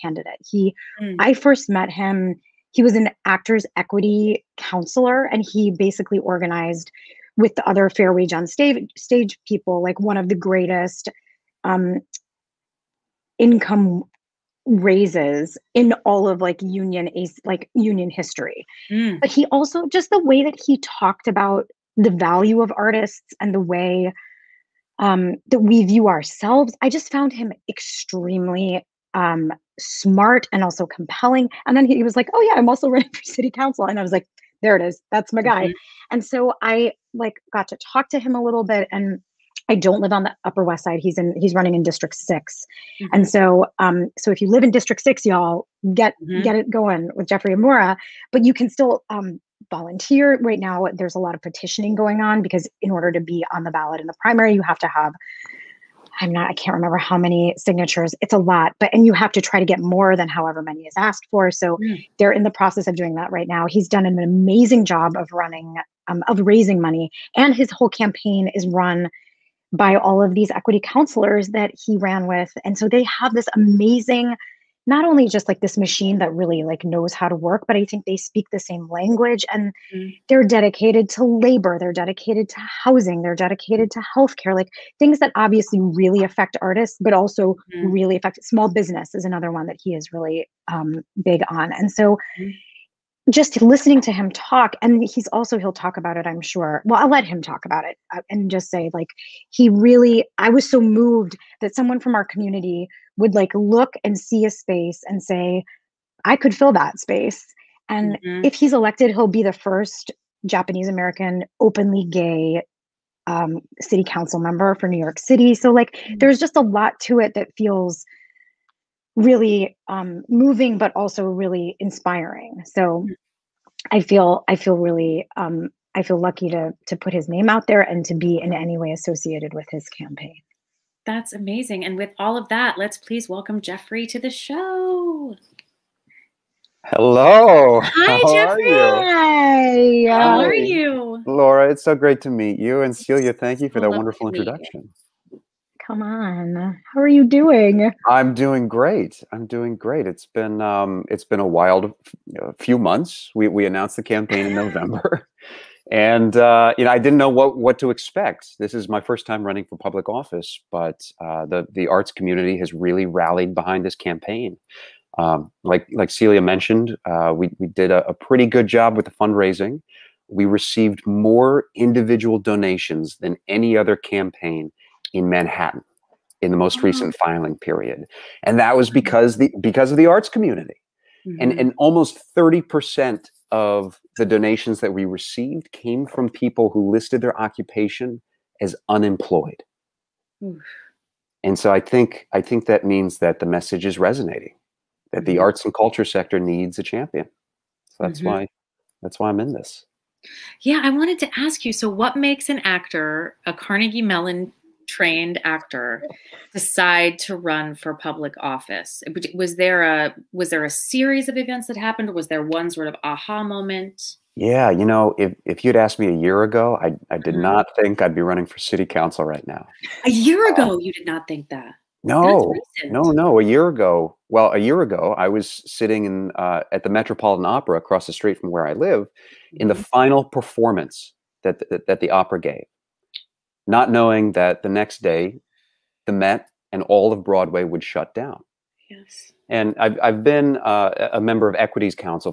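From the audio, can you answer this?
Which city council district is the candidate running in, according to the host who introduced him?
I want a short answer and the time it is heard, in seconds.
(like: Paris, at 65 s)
District 6, at 41 s.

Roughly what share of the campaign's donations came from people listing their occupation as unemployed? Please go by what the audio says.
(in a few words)
30%.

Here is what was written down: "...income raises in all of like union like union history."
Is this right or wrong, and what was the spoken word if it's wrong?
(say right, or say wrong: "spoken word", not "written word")
right.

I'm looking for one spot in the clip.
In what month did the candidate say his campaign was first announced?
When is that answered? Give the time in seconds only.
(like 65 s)
154 s.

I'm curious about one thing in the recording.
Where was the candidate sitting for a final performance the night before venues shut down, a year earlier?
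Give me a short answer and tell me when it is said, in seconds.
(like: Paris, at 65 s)
Metropolitan Opera, at 226 s.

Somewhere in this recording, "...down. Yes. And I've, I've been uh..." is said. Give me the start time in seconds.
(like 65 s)
238 s.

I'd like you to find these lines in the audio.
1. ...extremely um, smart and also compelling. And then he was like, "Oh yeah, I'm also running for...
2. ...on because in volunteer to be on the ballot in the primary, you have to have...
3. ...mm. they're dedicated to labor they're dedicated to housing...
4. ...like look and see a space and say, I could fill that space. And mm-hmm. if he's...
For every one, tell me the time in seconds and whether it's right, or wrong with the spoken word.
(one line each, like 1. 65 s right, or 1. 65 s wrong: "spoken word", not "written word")
1. 27 s right
2. 52 s wrong: "order", not "volunteer"
3. 79 s right
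4. 103 s right.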